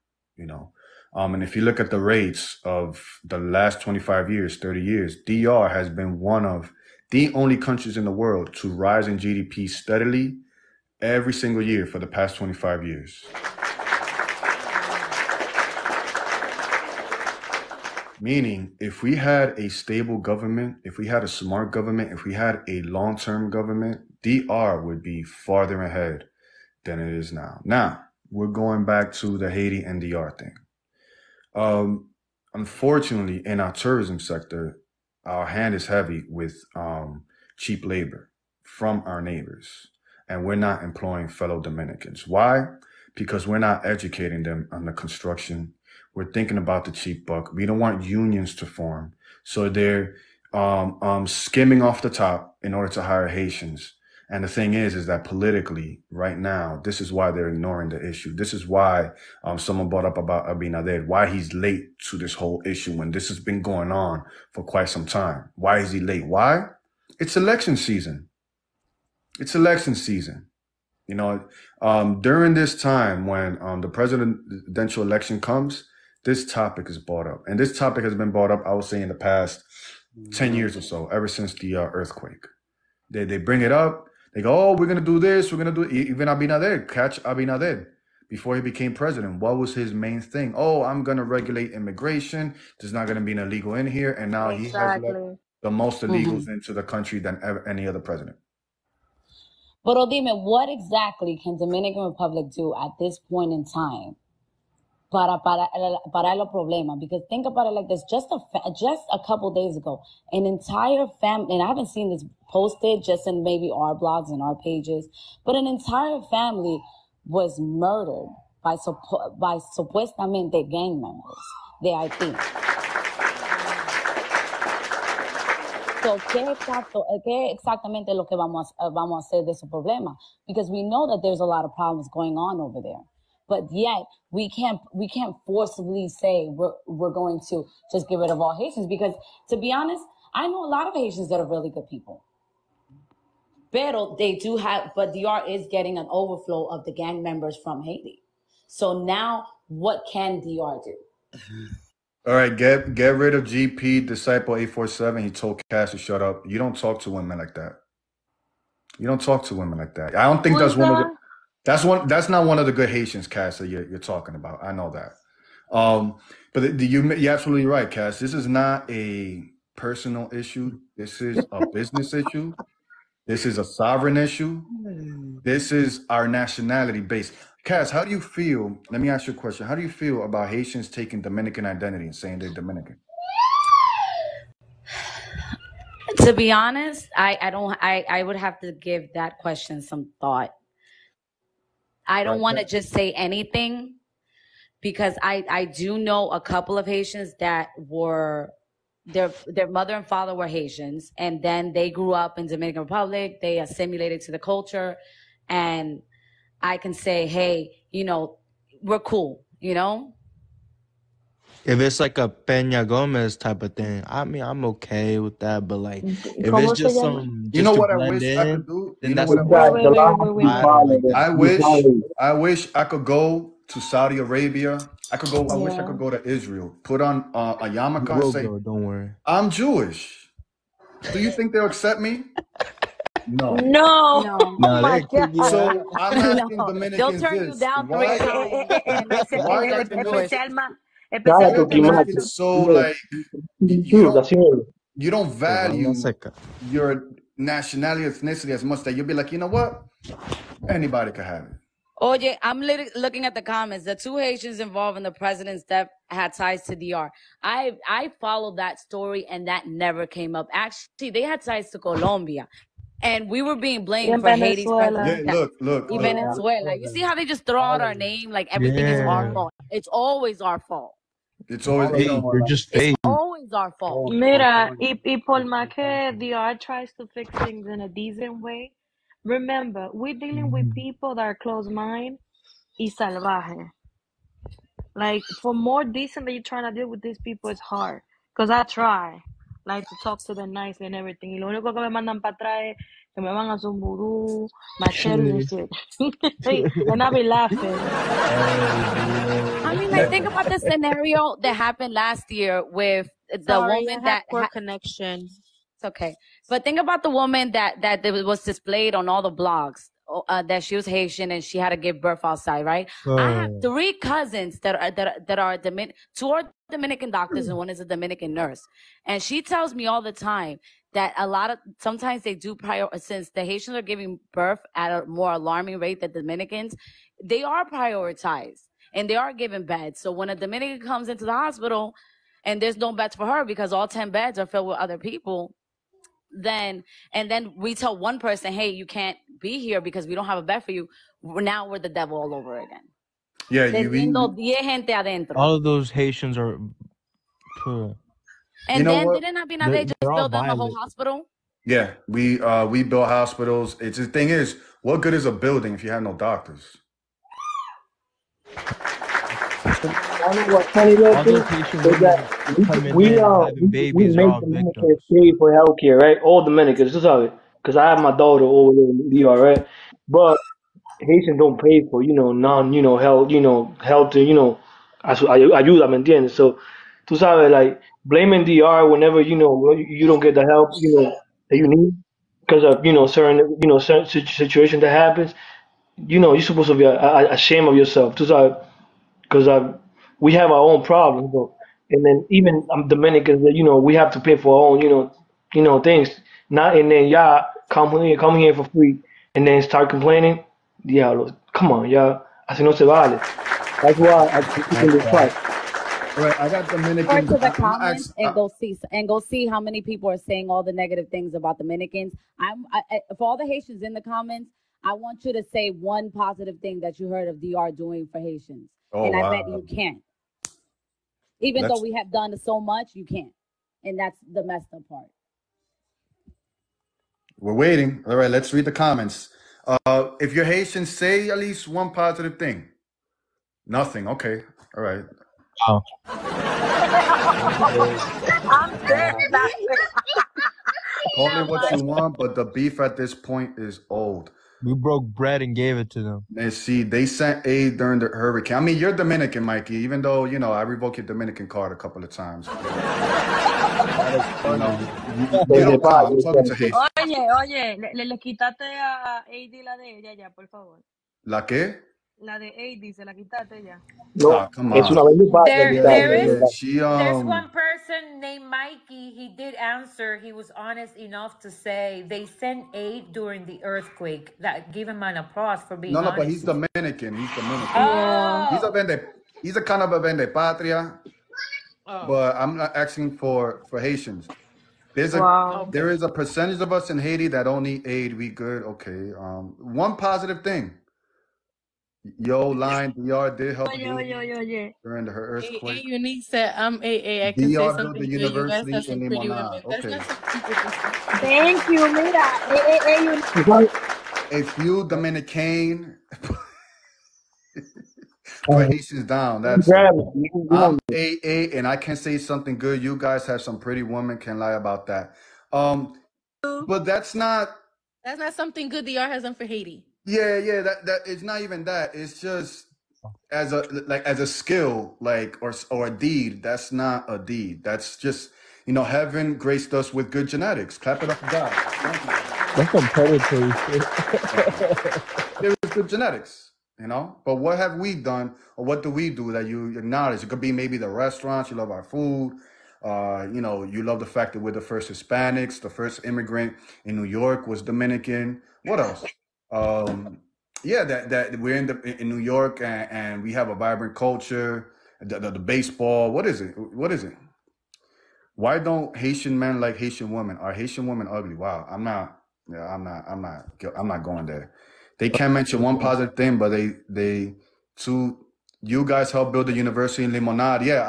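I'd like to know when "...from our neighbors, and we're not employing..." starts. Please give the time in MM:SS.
00:38.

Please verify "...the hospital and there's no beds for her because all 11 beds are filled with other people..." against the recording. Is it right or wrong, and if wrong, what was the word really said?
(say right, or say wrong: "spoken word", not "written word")
wrong: "10", not "11".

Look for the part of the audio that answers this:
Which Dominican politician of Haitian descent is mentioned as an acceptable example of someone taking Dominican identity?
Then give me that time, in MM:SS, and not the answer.
03:32.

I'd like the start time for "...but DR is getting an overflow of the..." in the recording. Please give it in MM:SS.
02:24.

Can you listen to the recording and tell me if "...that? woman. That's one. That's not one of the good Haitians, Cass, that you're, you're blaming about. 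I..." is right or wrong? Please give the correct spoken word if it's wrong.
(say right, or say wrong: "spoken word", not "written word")
wrong: "talking", not "blaming".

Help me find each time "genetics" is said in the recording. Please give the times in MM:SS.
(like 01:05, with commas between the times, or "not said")
08:50, 08:55.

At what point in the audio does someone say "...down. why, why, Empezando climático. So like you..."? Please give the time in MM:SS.
03:57.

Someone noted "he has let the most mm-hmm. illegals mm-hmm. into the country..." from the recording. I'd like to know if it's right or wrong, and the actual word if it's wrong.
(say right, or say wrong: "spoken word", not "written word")
right.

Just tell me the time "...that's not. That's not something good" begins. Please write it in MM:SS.
08:36.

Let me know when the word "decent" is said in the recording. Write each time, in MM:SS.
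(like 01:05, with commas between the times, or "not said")
04:37, 04:45.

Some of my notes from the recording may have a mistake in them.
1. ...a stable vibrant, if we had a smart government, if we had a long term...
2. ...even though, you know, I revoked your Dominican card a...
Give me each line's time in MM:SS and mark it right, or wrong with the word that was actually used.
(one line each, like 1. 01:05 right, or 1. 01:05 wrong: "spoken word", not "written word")
1. 00:19 wrong: "government", not "vibrant"
2. 07:29 right.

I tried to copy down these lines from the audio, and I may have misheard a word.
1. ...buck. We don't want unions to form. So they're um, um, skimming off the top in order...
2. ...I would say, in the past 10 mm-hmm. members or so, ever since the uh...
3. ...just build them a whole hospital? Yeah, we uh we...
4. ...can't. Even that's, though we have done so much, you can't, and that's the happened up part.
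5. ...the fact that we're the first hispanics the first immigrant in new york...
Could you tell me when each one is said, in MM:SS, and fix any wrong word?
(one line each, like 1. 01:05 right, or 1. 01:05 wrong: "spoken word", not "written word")
1. 00:47 right
2. 01:18 wrong: "years", not "members"
3. 05:49 right
4. 06:59 wrong: "messed", not "happened"
5. 09:03 right.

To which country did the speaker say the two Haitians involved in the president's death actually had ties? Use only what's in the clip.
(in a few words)
Colombia.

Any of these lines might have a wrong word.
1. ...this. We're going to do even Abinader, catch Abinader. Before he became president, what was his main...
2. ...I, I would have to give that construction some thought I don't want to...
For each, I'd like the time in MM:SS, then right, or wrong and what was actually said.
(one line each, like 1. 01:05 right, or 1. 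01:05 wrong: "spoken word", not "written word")
1. 01:25 right
2. 03:07 wrong: "question", not "construction".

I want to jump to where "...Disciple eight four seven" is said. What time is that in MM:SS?
02:34.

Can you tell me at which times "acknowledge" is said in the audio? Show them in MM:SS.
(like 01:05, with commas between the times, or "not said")
08:59.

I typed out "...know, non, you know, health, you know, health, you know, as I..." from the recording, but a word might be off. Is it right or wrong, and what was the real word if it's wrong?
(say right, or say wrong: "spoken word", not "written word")
right.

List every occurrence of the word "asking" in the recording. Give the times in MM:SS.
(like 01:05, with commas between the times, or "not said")
03:56, 08:02.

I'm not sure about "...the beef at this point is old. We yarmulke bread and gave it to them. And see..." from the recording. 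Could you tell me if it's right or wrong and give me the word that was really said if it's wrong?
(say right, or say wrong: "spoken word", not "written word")
wrong: "broke", not "yarmulke".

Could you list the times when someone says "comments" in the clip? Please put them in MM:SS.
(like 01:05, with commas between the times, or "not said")
04:13, 06:47, 06:54, 07:08.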